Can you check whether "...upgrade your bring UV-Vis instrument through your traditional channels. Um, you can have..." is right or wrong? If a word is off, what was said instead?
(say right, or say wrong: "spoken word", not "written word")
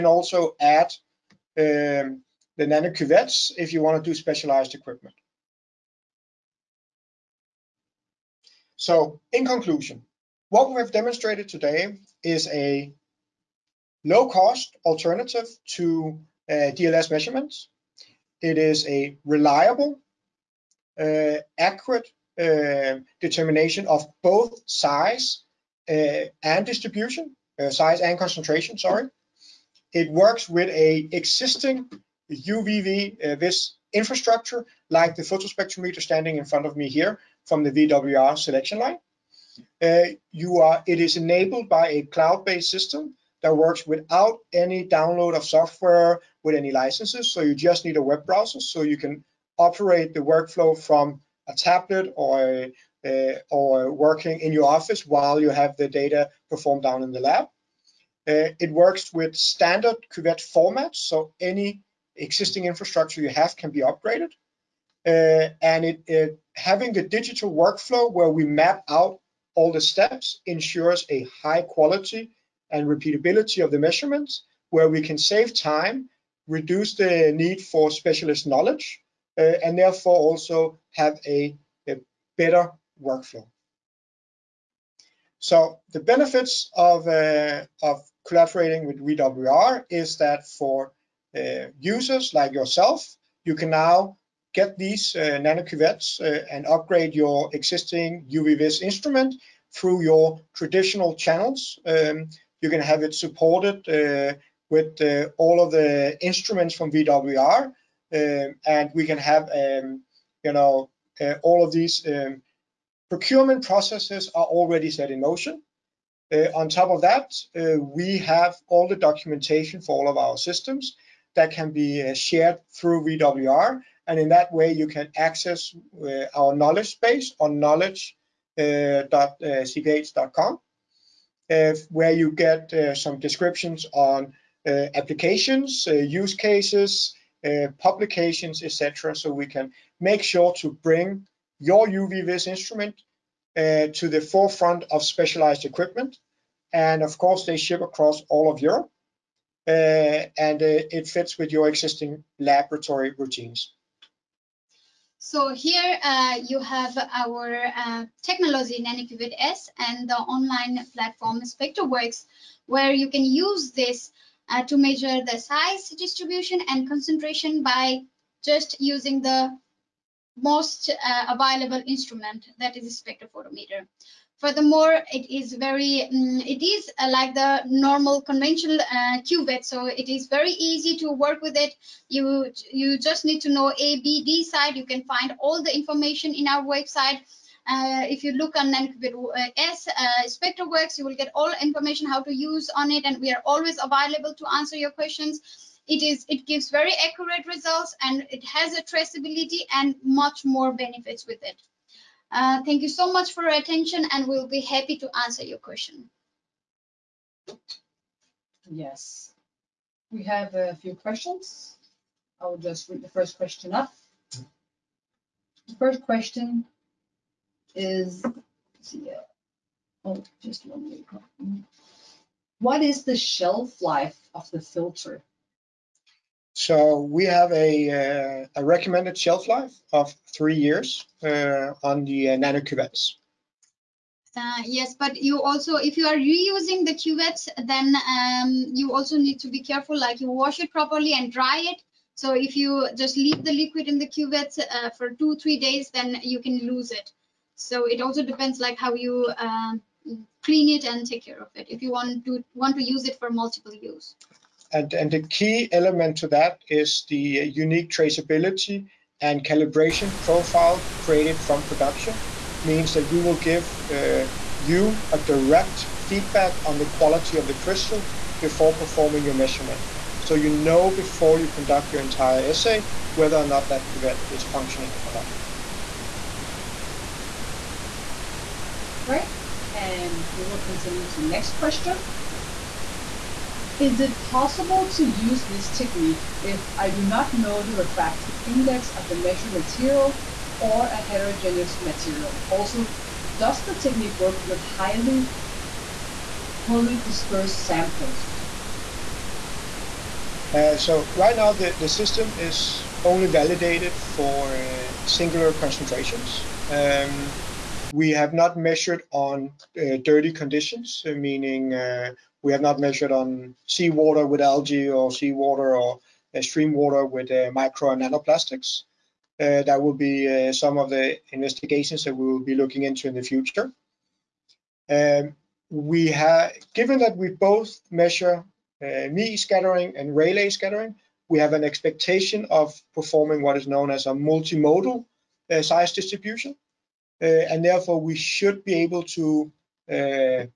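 wrong: "existing", not "bring".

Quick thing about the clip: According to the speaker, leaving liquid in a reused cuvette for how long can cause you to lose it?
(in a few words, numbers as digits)
2 to 3 days.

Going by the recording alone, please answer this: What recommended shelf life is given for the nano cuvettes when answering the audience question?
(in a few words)
3 years.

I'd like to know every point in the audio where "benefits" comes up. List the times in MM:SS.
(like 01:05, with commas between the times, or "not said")
01:25, 03:20.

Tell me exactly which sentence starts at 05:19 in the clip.
Uh, that will be uh, some of the investigations that we will be looking into in the future.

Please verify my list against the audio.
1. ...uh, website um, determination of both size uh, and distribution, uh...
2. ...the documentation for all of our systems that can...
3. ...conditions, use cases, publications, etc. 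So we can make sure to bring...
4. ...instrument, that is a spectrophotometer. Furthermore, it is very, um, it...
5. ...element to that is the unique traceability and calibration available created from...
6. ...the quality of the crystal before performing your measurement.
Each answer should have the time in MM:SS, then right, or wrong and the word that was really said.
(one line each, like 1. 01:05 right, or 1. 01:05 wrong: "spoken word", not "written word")
1. 00:20 wrong: "accurate", not "website"
2. 01:58 right
3. 02:14 wrong: "applications", not "conditions"
4. 02:51 right
5. 04:15 wrong: "profile", not "available"
6. 04:26 right.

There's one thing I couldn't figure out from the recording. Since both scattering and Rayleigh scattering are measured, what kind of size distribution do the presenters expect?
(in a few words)
multimodal.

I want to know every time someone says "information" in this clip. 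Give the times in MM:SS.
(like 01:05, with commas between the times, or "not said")
03:05, 03:11.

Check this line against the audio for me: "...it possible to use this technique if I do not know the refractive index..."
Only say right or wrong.
right.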